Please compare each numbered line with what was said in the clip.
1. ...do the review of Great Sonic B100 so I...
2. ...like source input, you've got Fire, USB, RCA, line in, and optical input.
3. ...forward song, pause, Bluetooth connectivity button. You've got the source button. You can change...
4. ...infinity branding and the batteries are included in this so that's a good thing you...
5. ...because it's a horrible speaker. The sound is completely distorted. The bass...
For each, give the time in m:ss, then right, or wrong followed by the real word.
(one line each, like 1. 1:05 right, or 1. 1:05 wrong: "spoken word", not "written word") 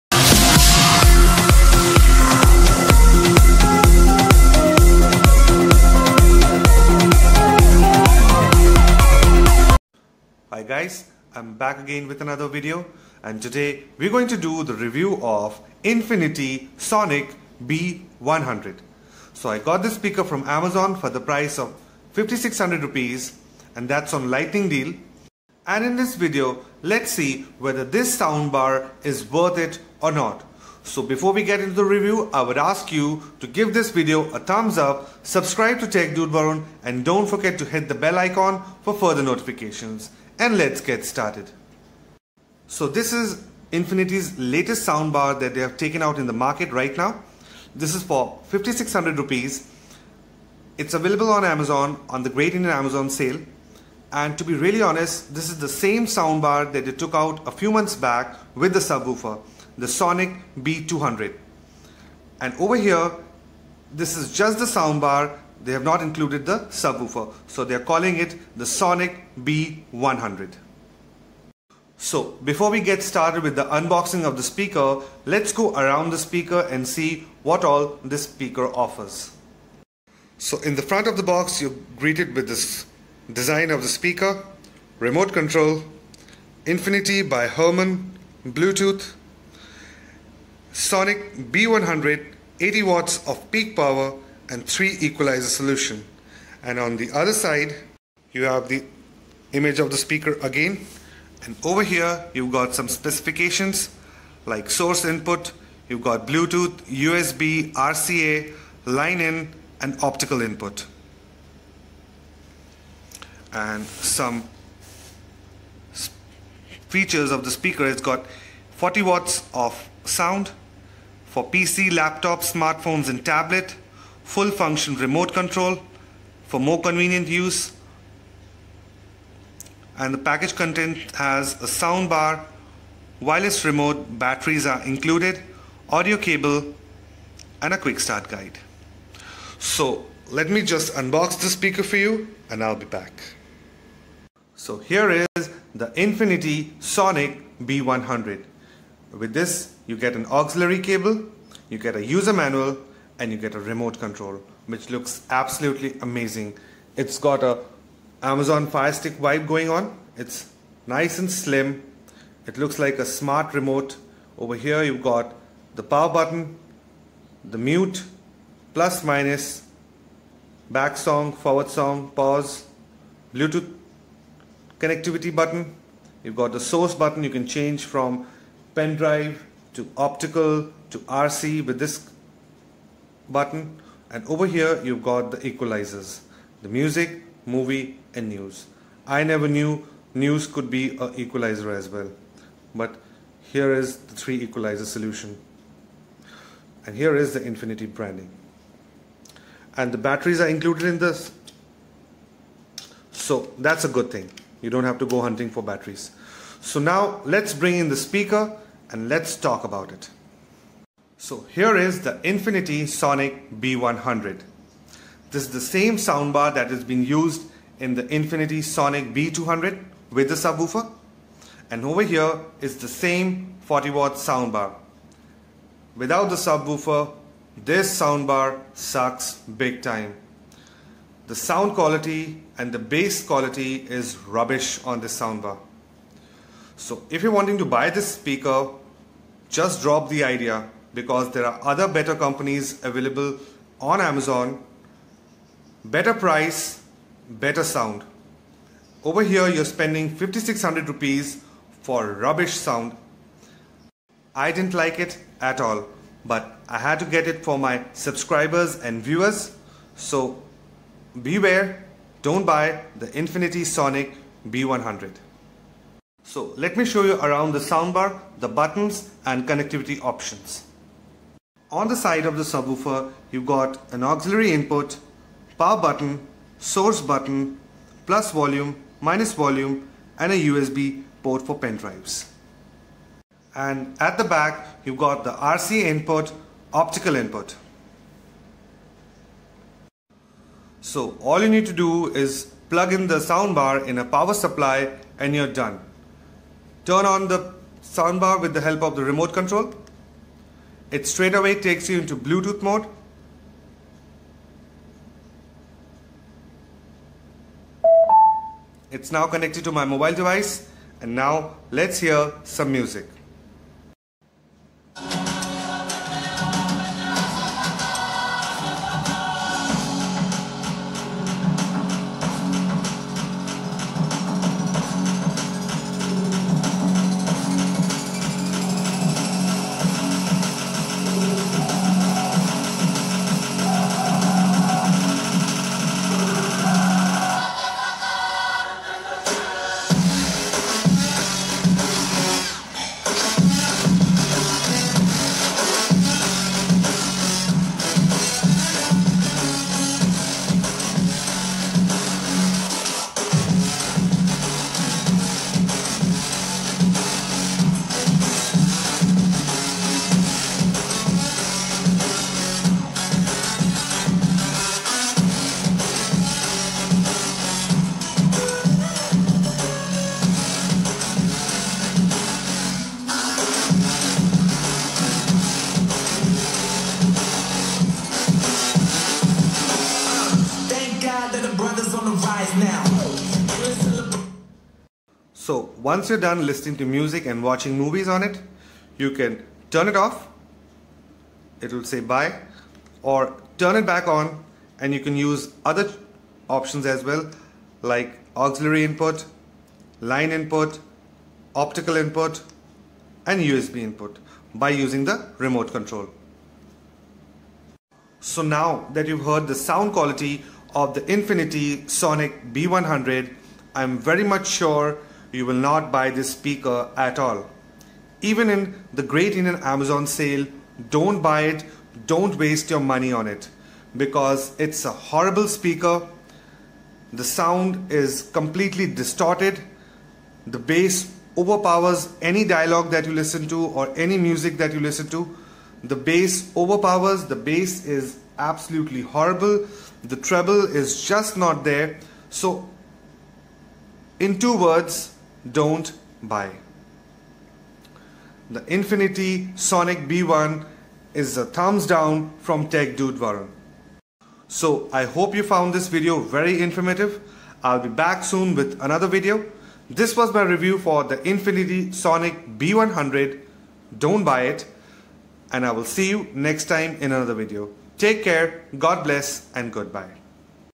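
1. 0:14 wrong: "Infinity", not "Great"
2. 1:44 wrong: "Bluetooth", not "Fire"
3. 2:51 right
4. 3:17 right
5. 7:03 right.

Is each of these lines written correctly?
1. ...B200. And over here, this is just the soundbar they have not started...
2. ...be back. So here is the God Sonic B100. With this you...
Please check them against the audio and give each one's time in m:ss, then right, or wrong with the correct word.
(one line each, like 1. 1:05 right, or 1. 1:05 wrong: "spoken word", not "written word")
1. 1:00 wrong: "included", not "started"
2. 2:22 wrong: "Infinity", not "God".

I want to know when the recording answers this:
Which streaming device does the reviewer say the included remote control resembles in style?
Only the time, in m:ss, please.
2:38.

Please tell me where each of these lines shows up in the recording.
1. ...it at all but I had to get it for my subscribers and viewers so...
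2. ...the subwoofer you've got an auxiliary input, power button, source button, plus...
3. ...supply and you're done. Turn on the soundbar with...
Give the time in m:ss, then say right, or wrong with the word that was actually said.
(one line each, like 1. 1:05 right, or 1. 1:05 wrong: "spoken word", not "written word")
1. 4:14 right
2. 4:32 right
3. 4:54 right.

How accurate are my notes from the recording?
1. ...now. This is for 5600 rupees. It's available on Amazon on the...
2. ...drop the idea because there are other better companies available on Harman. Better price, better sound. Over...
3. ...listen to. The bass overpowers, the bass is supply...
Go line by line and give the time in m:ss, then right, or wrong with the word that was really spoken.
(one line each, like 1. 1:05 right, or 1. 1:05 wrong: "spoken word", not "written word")
1. 0:46 right
2. 3:59 wrong: "Amazon", not "Harman"
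3. 7:14 wrong: "absolutely", not "supply".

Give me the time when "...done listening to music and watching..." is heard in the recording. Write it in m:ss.
6:26.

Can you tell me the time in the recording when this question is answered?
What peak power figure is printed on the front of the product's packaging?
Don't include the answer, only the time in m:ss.
1:32.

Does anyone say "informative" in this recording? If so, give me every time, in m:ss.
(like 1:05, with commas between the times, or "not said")
7:36.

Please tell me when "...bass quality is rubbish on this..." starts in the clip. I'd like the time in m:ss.
3:52.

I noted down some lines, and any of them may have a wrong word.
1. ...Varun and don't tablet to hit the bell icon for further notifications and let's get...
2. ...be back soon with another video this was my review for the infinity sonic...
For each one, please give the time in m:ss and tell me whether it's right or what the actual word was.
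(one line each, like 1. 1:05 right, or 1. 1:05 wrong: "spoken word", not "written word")
1. 0:36 wrong: "forget", not "tablet"
2. 7:37 right.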